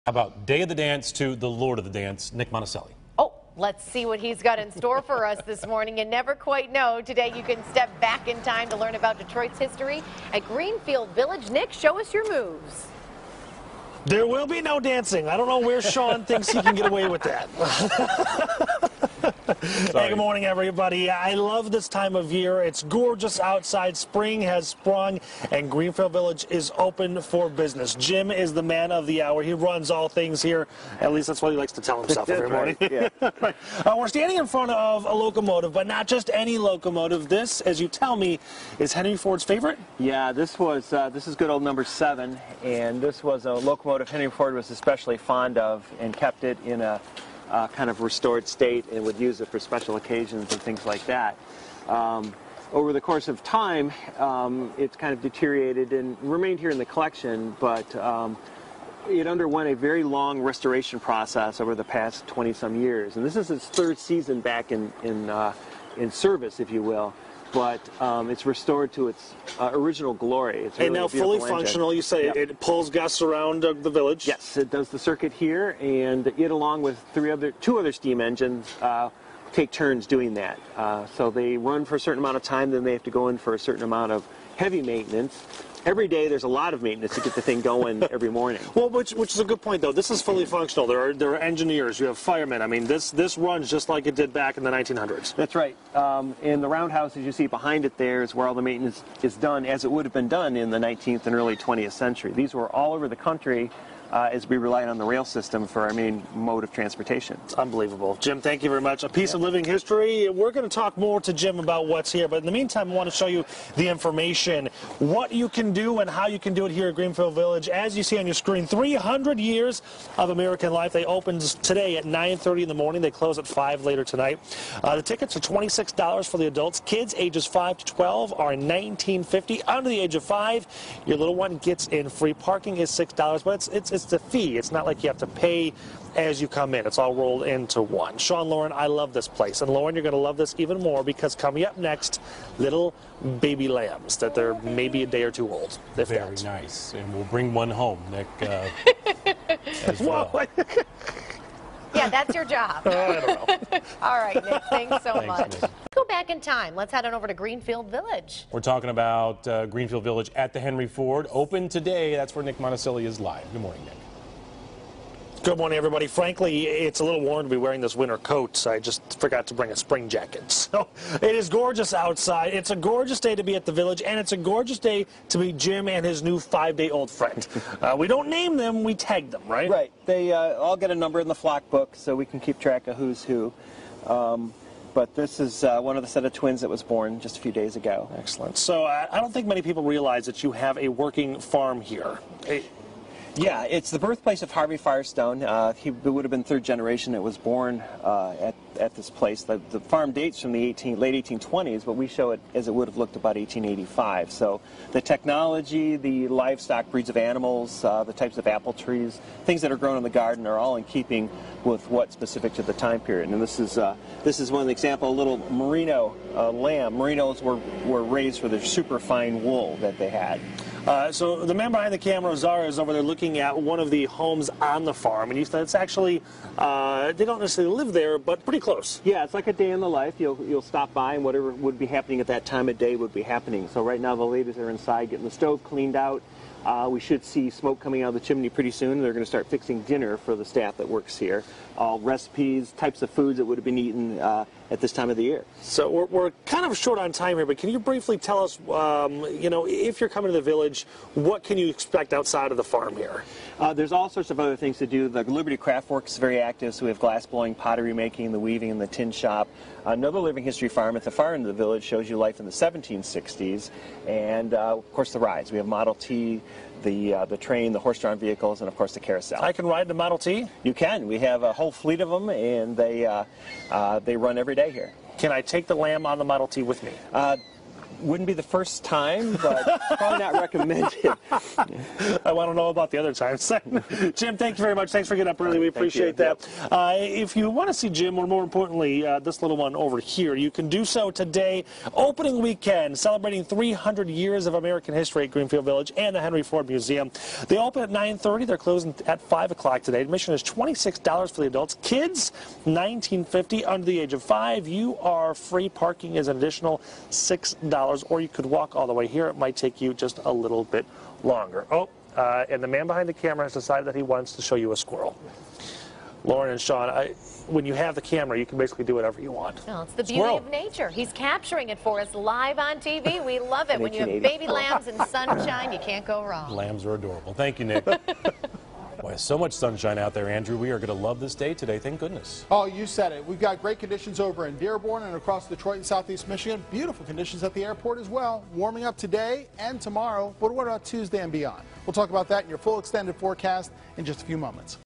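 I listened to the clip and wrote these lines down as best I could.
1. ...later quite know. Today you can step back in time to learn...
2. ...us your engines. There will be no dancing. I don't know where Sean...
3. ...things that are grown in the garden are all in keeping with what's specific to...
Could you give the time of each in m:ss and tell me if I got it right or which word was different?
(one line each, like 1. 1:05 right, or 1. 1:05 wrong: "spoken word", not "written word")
1. 0:06 wrong: "never", not "later"
2. 0:12 wrong: "moves", not "engines"
3. 3:29 right.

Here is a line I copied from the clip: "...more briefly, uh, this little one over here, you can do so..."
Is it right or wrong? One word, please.
wrong.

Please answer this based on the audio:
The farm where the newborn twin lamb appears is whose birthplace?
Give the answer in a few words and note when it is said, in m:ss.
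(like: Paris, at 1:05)
Harvey Firestone, at 3:14.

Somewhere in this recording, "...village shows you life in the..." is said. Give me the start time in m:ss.
4:21.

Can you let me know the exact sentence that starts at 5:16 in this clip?
Lauren and Sean, I, when you have the camera, you can basically do whatever you want.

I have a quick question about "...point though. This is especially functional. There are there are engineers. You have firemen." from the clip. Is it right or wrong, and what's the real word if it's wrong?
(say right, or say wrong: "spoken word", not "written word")
wrong: "fully", not "especially".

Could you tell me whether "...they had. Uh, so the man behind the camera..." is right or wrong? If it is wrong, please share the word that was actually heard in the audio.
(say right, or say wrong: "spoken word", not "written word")
right.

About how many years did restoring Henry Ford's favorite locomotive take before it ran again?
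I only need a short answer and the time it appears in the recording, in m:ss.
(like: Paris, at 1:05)
20 some years, at 1:02.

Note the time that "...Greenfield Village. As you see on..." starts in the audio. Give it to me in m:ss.
1:56.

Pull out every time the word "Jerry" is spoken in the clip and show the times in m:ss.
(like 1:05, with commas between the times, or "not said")
not said.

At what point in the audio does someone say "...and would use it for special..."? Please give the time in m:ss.
0:48.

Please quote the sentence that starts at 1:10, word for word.
It's really and now fully engine.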